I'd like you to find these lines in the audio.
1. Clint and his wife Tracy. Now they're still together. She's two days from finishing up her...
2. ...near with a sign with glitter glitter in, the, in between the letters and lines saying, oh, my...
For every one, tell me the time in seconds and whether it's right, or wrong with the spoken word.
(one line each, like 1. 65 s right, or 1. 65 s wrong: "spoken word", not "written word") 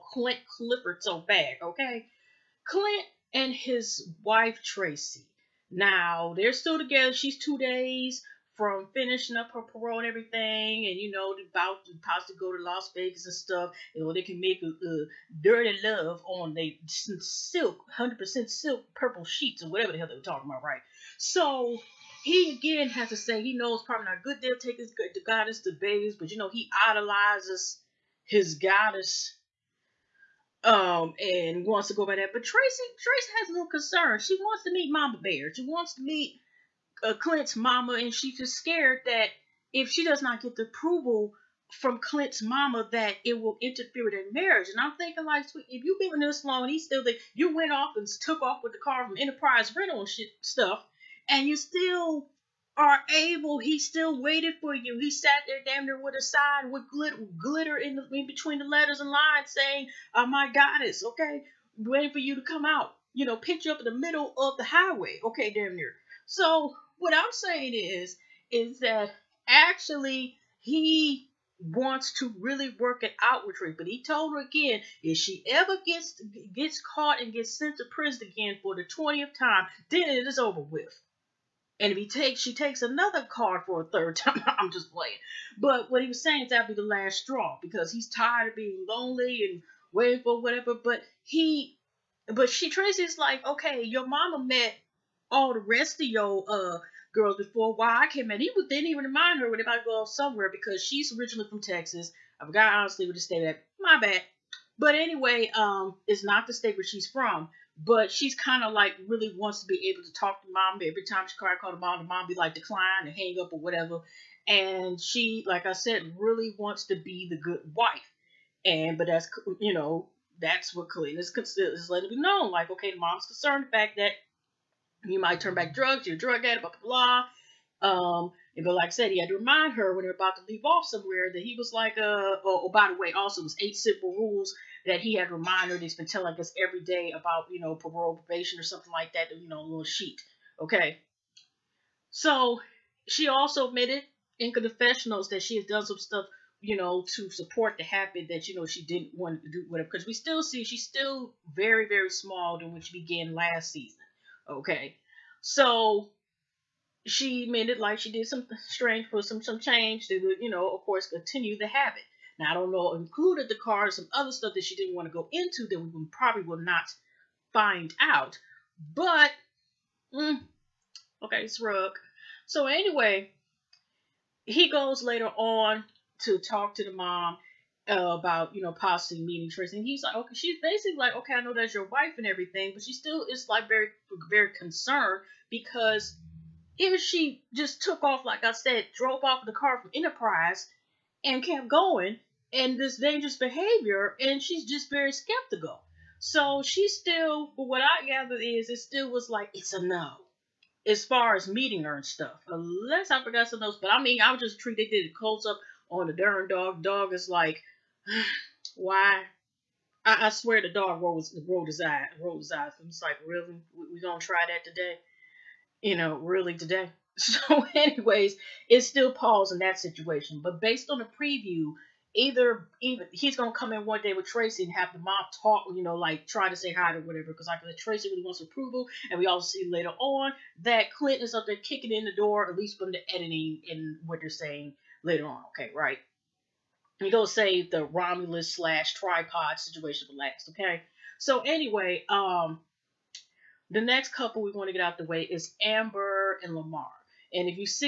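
1. 2 s right
2. 55 s right.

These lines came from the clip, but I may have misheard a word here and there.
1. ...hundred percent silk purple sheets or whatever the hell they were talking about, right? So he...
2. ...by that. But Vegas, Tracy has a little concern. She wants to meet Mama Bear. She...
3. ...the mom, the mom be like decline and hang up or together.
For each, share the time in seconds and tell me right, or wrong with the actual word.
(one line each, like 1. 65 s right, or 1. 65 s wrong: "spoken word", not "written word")
1. 17 s right
2. 32 s wrong: "Tracy", not "Vegas"
3. 111 s wrong: "whatever", not "together".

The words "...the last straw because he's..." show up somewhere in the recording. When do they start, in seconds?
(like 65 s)
86 s.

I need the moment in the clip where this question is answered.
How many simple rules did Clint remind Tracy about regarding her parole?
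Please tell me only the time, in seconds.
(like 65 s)
133 s.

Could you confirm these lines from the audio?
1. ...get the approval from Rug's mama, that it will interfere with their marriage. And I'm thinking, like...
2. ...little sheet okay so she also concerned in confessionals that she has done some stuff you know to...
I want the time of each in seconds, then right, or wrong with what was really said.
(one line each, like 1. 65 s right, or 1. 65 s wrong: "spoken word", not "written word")
1. 40 s wrong: "Clint", not "Rug"
2. 139 s wrong: "admitted", not "concerned".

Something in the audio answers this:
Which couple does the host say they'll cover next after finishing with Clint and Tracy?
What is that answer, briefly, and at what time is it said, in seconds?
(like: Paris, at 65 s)
Amber and Lamar, at 245 s.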